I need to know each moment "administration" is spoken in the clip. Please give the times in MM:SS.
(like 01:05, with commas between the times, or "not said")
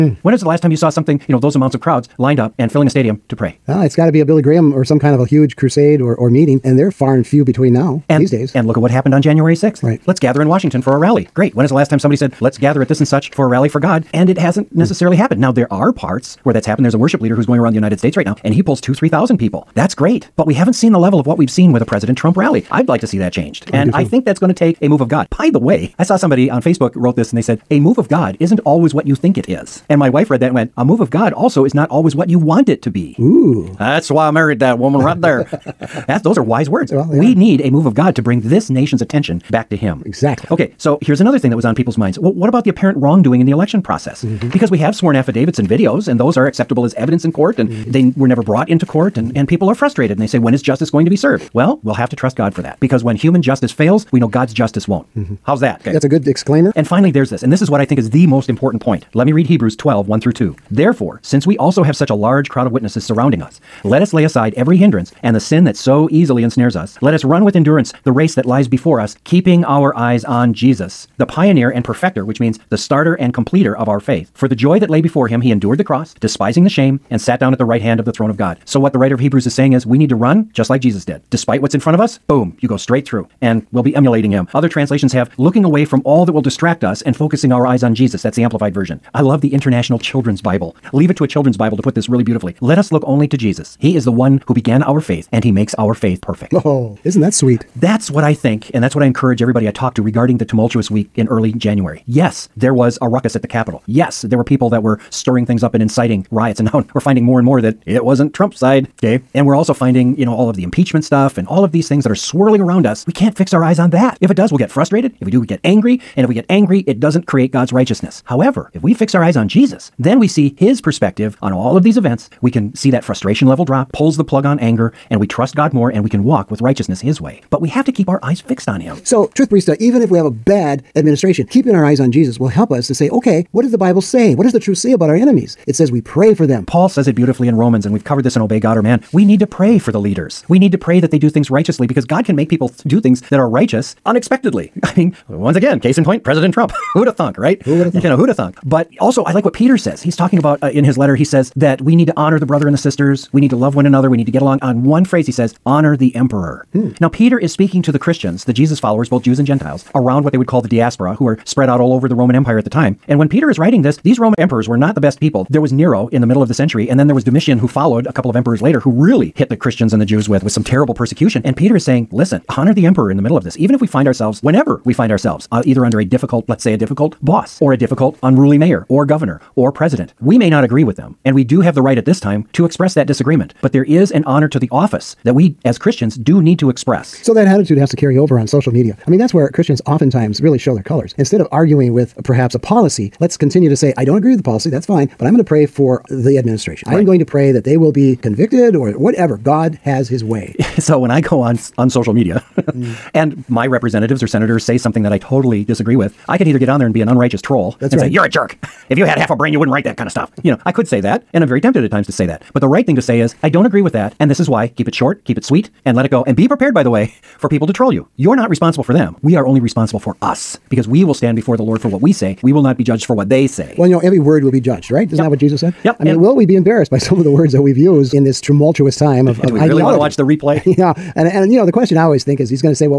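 02:10, 03:16.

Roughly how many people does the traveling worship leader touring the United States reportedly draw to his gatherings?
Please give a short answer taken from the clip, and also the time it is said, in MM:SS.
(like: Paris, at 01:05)
2,000-3,000, at 00:18.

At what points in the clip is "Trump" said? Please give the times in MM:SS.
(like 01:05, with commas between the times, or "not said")
00:22, 01:48, 02:26.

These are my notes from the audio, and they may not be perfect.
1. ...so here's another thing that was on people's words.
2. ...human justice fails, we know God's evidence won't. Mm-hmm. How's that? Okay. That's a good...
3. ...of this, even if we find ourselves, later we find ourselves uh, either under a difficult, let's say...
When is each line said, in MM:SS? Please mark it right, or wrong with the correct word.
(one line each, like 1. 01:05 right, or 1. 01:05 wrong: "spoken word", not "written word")
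1. 00:40 wrong: "minds", not "words"
2. 00:53 wrong: "justice", not "evidence"
3. 02:53 wrong: "whenever", not "later".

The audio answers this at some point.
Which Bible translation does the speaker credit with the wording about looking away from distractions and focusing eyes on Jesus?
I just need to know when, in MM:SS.
01:28.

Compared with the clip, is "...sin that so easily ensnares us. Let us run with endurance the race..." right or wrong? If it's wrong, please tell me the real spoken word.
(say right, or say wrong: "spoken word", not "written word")
right.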